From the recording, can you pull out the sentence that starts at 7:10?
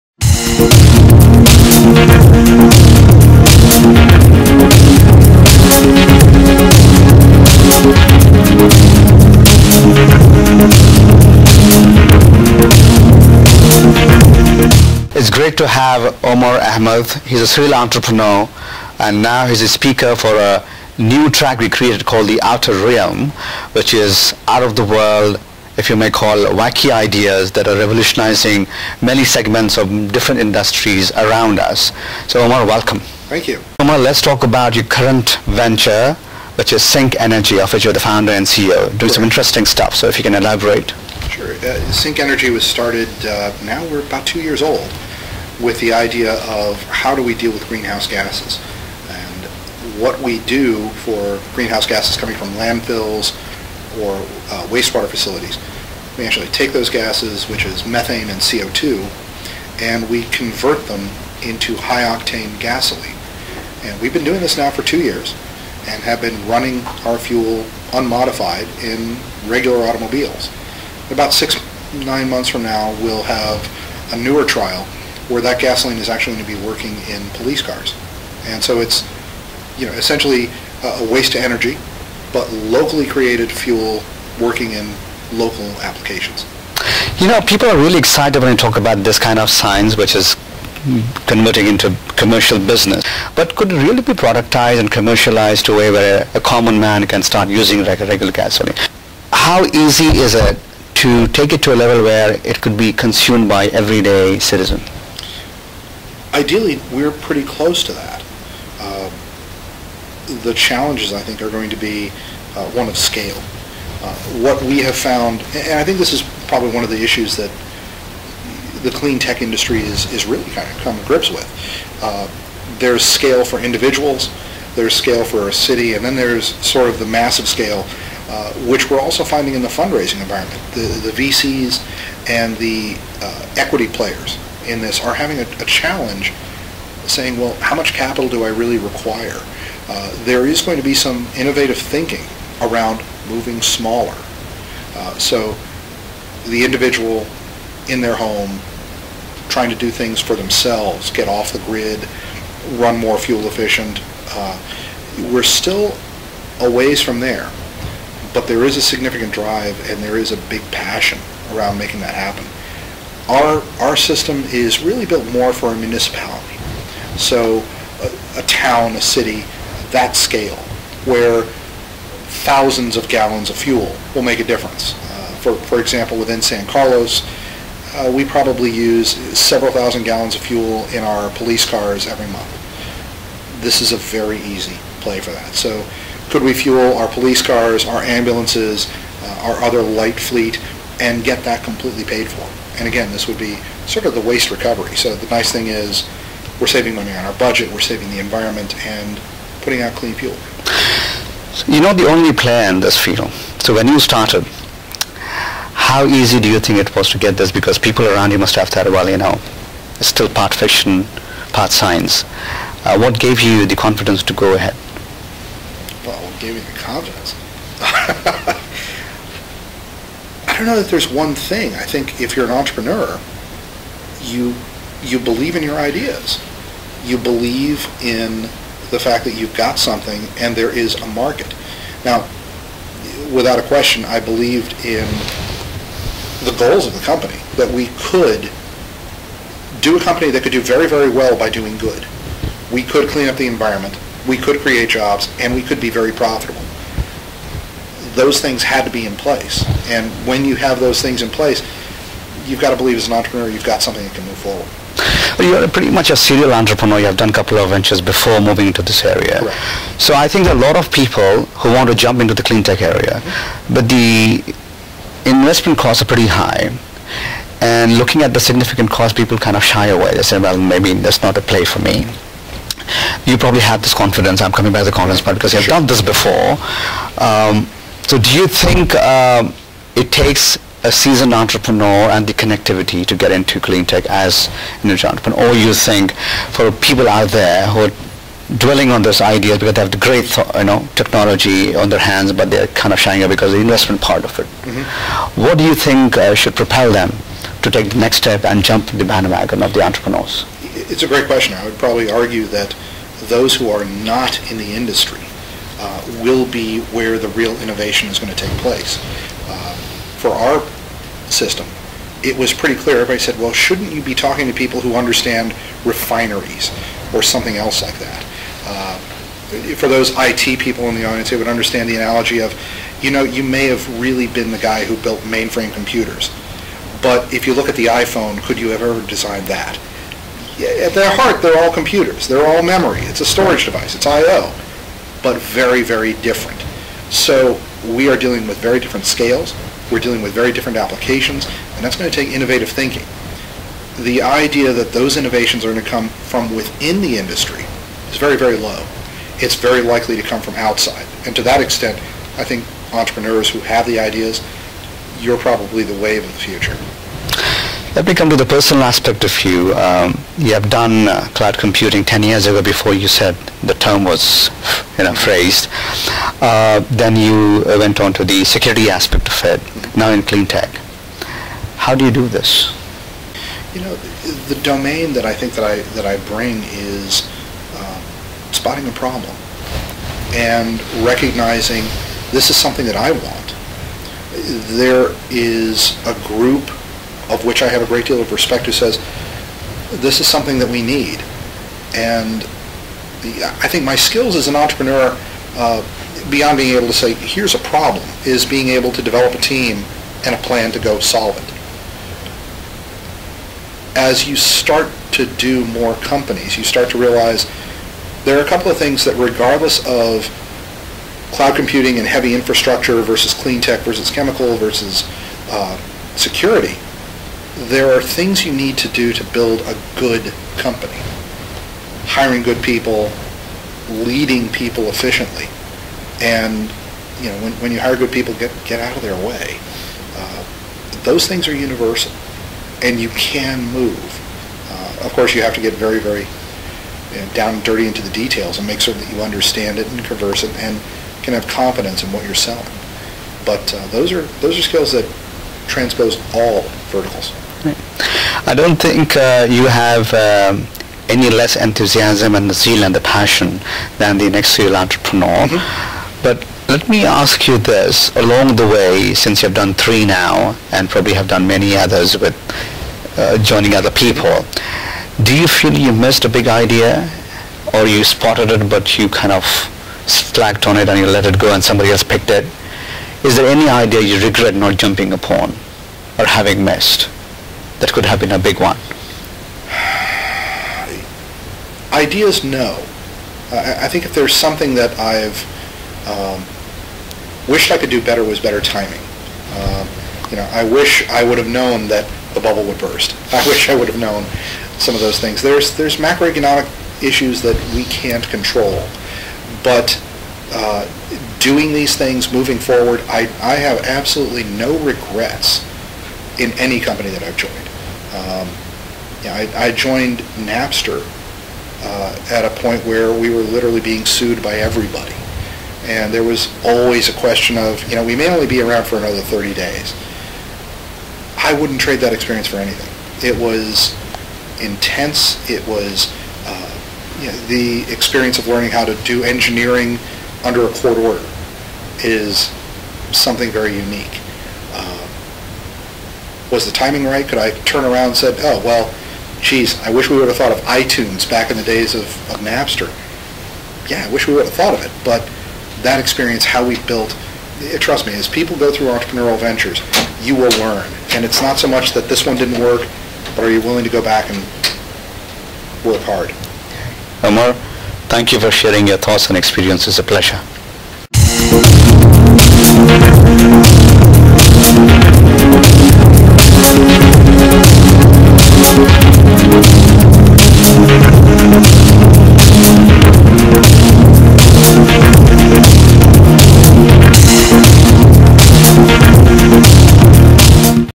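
Uh, those things are universal, and you can move.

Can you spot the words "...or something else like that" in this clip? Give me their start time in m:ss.
5:17.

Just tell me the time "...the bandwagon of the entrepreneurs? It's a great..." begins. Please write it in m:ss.
4:58.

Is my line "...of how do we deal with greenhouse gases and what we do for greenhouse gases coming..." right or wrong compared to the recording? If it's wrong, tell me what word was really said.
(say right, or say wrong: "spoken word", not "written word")
right.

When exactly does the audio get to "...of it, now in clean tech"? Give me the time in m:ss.
6:09.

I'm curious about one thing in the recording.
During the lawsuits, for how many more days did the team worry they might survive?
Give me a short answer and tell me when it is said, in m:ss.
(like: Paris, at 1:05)
30, at 8:39.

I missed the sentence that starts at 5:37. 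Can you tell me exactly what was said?
So we are dealing with very different scales, we're dealing with very different applications, and that's going to take innovative thinking.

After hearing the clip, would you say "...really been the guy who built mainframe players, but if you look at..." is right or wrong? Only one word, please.
wrong.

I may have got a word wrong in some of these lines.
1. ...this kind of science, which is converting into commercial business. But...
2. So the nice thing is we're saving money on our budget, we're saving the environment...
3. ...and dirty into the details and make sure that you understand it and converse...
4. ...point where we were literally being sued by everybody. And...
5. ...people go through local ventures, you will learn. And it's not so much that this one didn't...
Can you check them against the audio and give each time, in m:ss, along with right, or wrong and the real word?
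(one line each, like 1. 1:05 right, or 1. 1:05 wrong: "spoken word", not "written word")
1. 1:29 right
2. 3:14 right
3. 7:17 right
4. 8:32 right
5. 9:08 wrong: "entrepreneurial", not "local".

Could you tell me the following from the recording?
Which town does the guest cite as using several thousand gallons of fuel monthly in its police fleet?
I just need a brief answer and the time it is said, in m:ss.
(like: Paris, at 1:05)
San Carlos, at 2:56.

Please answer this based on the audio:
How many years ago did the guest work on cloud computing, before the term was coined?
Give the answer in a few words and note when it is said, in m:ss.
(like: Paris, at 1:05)
10, at 6:02.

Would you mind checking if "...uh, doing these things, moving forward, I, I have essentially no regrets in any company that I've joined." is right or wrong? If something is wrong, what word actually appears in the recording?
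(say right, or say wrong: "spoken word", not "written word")
wrong: "absolutely", not "essentially".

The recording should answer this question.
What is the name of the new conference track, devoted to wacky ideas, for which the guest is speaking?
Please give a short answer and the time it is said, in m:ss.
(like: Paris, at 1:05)
The Outer Realm, at 0:22.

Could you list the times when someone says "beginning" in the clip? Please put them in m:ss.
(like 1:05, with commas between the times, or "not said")
not said.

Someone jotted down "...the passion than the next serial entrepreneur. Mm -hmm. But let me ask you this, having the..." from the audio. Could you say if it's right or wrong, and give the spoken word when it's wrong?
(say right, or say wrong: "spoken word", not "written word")
wrong: "along", not "having".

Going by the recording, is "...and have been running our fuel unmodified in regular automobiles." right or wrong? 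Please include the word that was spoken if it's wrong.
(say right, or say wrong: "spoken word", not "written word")
right.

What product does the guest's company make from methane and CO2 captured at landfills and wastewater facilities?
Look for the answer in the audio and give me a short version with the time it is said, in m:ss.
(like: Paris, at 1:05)
high octane gasoline, at 1:01.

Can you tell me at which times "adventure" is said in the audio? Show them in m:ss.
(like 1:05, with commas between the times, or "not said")
not said.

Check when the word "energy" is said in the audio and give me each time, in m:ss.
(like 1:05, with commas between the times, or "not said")
0:37, 0:42, 1:21.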